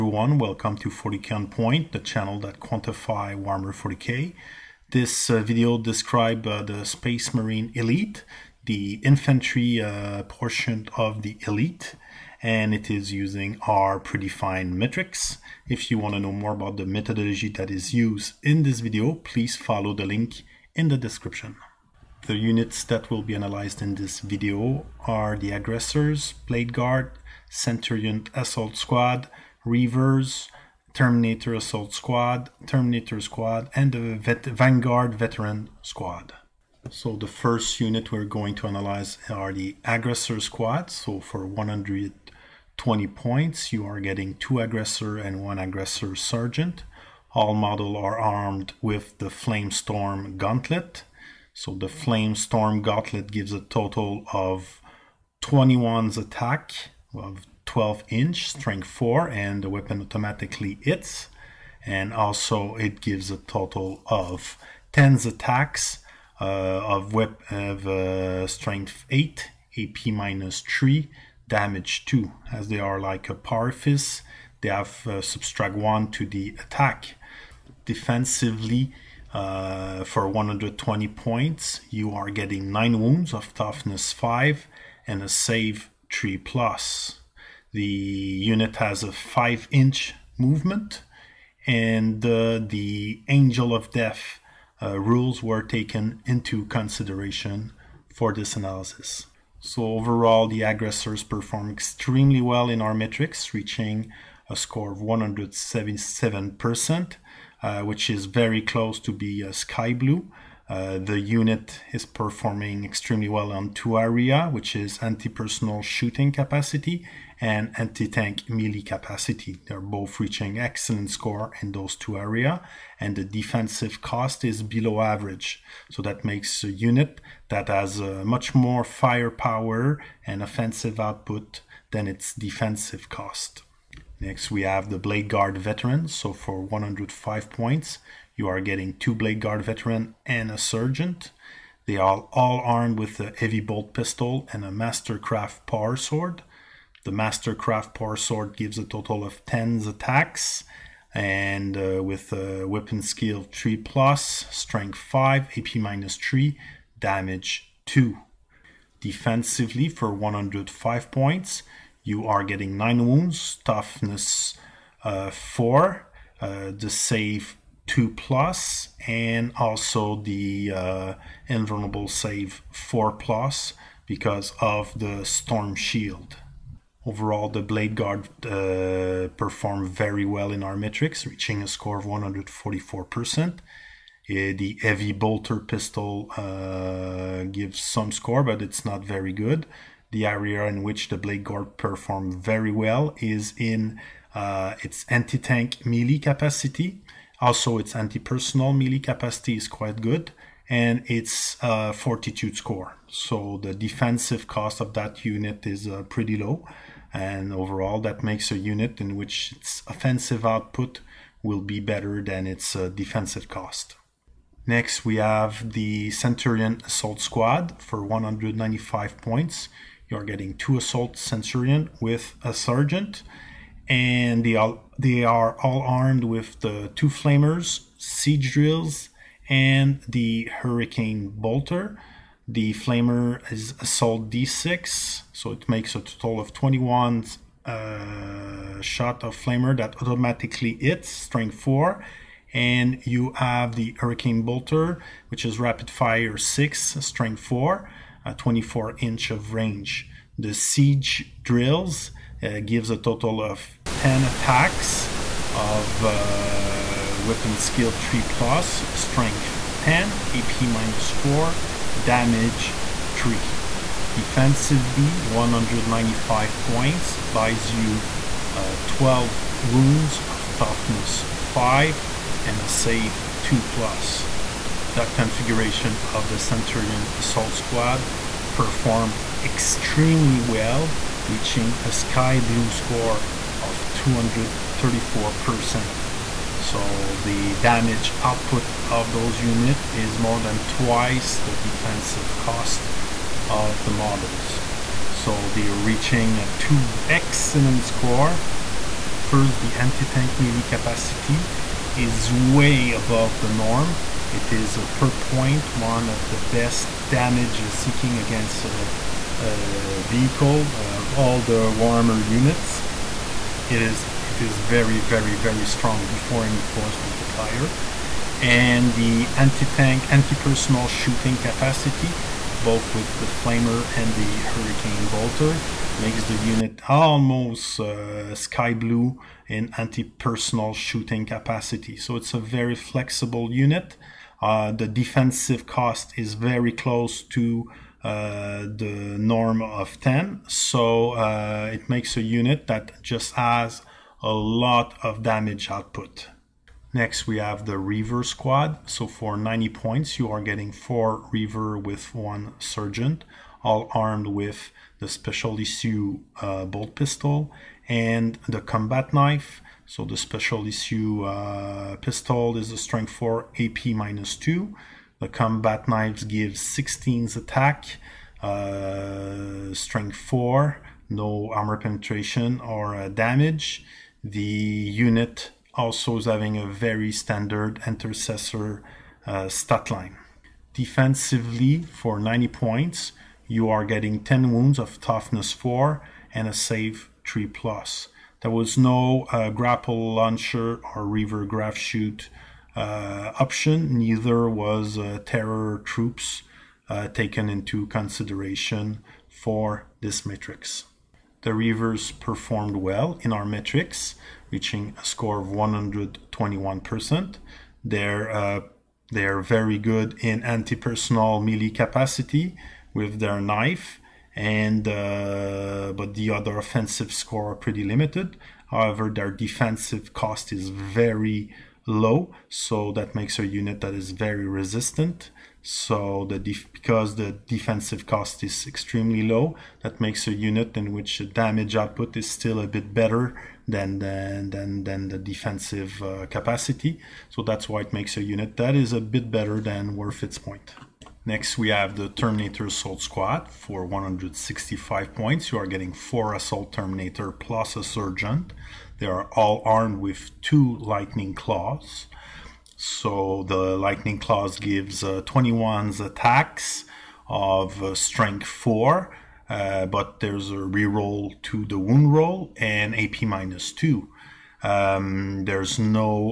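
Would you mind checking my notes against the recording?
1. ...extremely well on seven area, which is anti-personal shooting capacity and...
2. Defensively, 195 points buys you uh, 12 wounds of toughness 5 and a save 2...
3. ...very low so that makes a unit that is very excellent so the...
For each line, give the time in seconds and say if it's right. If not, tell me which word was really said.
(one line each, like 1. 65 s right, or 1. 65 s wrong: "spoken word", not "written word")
1. 112 s wrong: "two", not "seven"
2. 264 s right
3. 420 s wrong: "resistant", not "excellent".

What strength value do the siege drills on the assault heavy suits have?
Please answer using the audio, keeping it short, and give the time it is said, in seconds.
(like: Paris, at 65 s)
10, at 258 s.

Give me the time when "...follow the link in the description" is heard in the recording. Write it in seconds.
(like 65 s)
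19 s.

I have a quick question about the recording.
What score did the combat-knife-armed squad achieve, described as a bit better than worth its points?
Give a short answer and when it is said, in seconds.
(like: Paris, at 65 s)
121%, at 405 s.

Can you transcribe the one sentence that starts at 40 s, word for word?
So for 120 points, you are getting two Aggressor and one Aggressor Sergeant.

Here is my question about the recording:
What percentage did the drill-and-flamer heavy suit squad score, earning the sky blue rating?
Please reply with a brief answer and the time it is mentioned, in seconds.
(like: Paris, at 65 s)
234%, at 283 s.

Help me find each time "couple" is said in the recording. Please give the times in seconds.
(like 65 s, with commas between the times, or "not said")
not said.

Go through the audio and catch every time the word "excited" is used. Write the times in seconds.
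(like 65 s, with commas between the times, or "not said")
not said.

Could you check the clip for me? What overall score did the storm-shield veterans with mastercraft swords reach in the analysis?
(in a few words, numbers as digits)
144%.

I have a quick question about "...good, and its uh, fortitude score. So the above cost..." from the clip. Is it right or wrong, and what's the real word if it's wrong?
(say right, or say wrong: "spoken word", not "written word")
wrong: "defensive", not "above".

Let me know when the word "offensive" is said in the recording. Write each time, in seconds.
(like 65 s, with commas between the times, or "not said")
130 s, 209 s, 416 s.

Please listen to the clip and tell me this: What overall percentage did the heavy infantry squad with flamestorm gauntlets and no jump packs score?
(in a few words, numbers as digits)
177%.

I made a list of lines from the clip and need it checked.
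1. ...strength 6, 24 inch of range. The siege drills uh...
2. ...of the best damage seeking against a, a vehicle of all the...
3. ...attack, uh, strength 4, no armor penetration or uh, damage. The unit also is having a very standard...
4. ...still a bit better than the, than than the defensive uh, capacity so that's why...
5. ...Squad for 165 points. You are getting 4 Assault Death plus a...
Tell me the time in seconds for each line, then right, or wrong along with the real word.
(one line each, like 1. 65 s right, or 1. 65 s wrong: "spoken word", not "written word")
1. 247 s wrong: "4", not "6"
2. 306 s right
3. 367 s right
4. 432 s right
5. 443 s wrong: "Terminator", not "Death".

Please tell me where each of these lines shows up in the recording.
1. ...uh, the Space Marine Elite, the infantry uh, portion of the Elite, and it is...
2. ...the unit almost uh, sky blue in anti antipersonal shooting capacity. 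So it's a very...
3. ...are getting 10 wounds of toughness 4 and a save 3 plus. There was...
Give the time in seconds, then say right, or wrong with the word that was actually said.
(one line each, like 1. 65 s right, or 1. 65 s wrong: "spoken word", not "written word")
1. 6 s right
2. 326 s wrong: "personal", not "antipersonal"
3. 383 s right.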